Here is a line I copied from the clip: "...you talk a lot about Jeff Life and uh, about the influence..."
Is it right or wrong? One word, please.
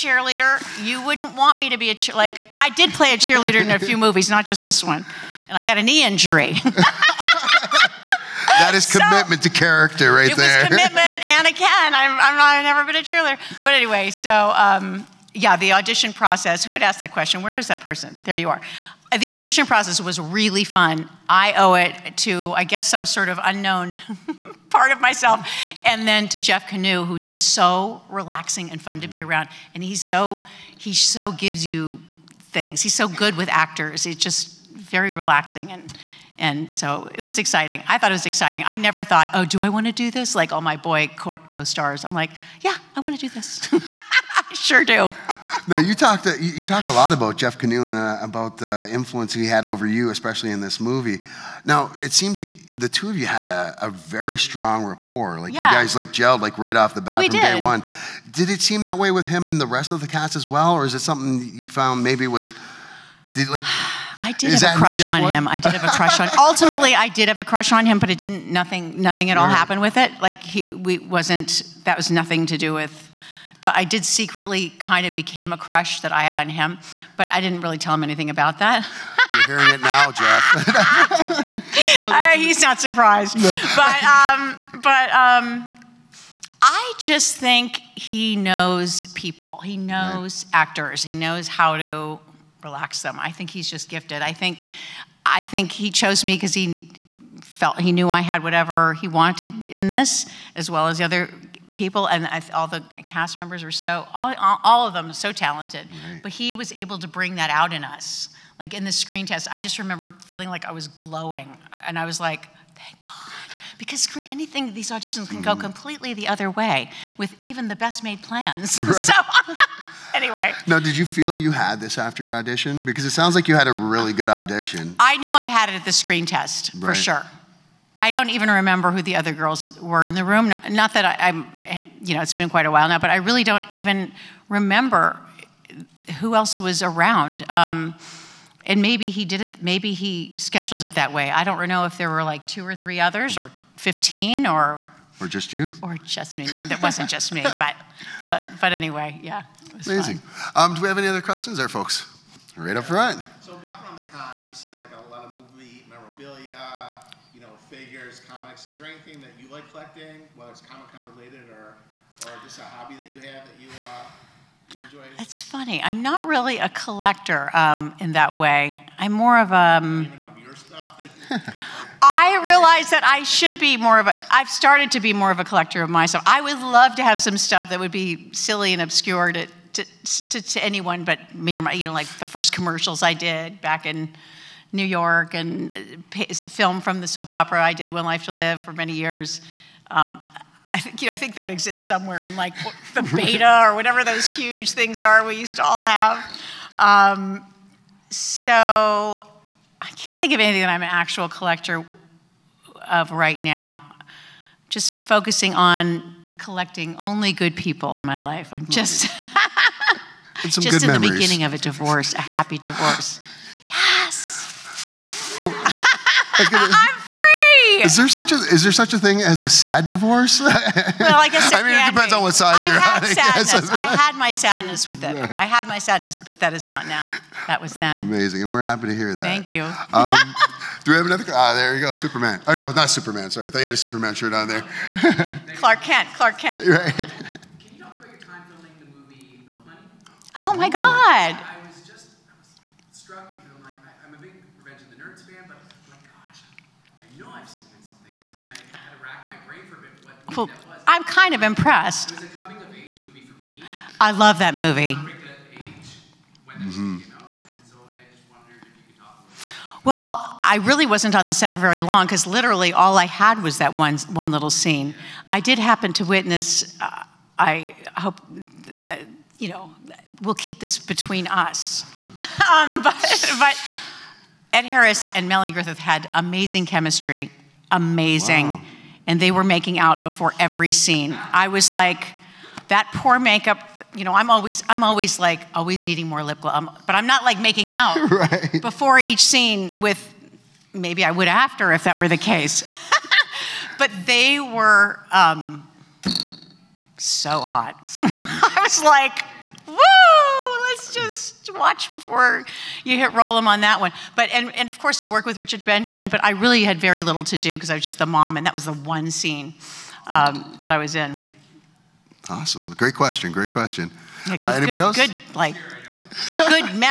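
wrong.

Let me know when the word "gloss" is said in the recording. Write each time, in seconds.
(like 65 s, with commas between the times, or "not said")
286 s.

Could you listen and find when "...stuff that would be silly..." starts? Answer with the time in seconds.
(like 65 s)
177 s.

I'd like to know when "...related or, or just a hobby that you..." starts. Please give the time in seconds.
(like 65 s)
161 s.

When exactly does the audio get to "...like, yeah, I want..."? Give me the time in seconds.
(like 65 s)
42 s.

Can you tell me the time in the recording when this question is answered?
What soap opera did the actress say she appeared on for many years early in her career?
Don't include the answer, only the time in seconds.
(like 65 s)
187 s.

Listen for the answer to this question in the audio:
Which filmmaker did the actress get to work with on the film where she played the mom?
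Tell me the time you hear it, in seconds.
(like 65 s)
305 s.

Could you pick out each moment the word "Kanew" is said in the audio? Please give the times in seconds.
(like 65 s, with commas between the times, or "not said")
26 s, 47 s.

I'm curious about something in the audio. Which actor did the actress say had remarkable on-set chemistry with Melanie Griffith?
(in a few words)
Ed Harris.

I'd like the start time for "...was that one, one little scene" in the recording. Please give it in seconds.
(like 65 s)
263 s.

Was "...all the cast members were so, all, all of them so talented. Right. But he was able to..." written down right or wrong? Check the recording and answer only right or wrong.
right.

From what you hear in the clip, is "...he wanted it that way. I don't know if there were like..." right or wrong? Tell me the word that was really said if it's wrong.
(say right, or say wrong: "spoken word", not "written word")
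wrong: "scheduled", not "wanted".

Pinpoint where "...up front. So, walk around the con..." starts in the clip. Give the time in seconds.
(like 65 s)
152 s.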